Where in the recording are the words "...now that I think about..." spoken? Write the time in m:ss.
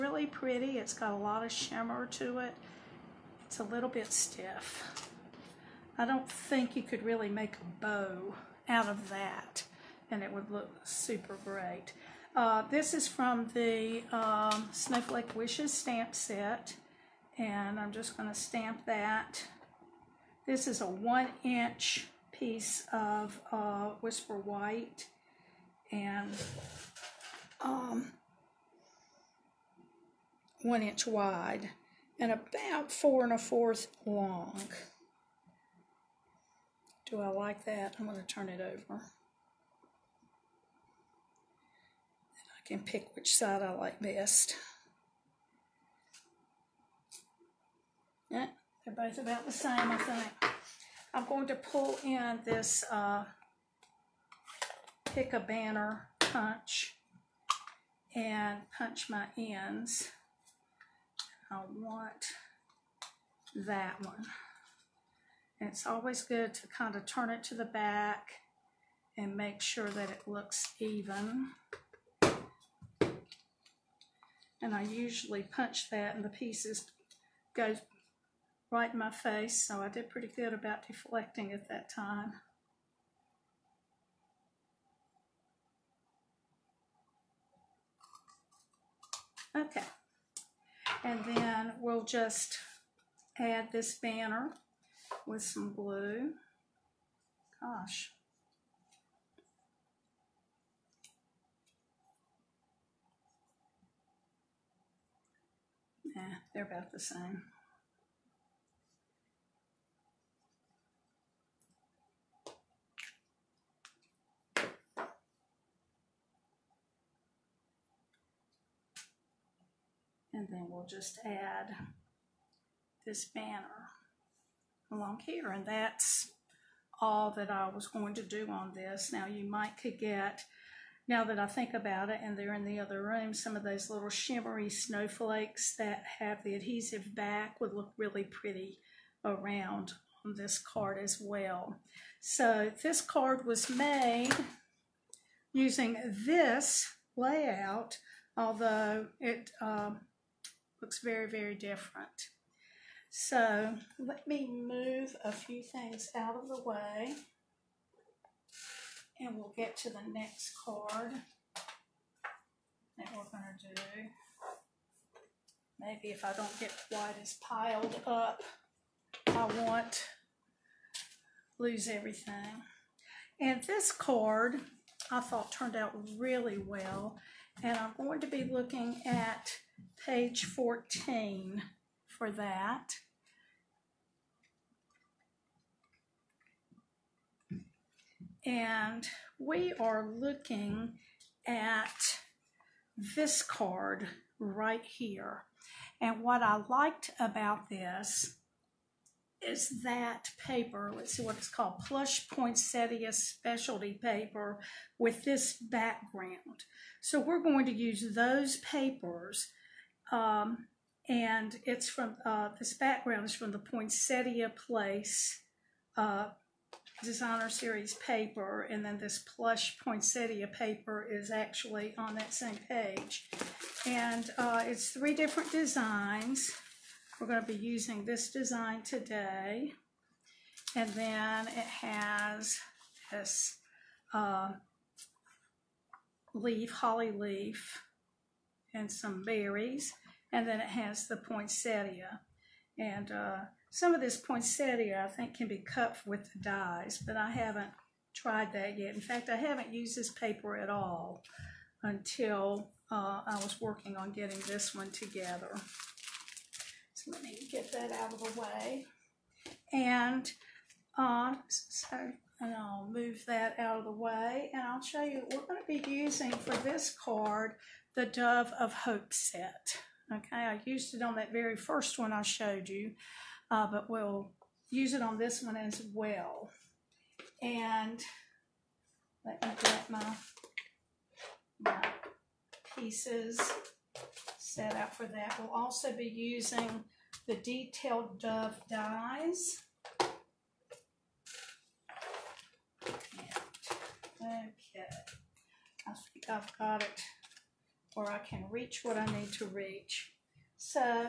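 2:11.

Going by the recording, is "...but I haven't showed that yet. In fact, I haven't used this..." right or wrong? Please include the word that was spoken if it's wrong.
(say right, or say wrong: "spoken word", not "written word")
wrong: "tried", not "showed".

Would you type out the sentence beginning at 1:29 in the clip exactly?
Okay, and then we'll just add this banner with some glue.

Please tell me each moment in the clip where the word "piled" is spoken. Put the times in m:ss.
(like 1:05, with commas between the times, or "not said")
2:47.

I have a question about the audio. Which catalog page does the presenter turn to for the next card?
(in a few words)
14.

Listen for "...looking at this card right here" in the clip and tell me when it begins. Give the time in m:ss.
3:10.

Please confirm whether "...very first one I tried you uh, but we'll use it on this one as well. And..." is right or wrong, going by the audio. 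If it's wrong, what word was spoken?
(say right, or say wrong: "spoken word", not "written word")
wrong: "showed", not "tried".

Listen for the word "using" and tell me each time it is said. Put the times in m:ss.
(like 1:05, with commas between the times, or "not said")
2:25, 3:47, 4:25, 4:46.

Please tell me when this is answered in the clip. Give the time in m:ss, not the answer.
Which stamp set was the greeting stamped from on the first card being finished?
0:14.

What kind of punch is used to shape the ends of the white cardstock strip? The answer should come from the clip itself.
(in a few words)
Pick a banner punch.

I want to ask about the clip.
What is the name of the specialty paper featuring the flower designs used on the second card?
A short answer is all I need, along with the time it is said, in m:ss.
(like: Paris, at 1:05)
Plush Poinsettia Specialty Paper, at 3:21.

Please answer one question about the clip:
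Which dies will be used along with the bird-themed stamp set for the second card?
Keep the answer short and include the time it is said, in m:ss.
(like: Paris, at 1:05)
Detailed dove dies, at 4:47.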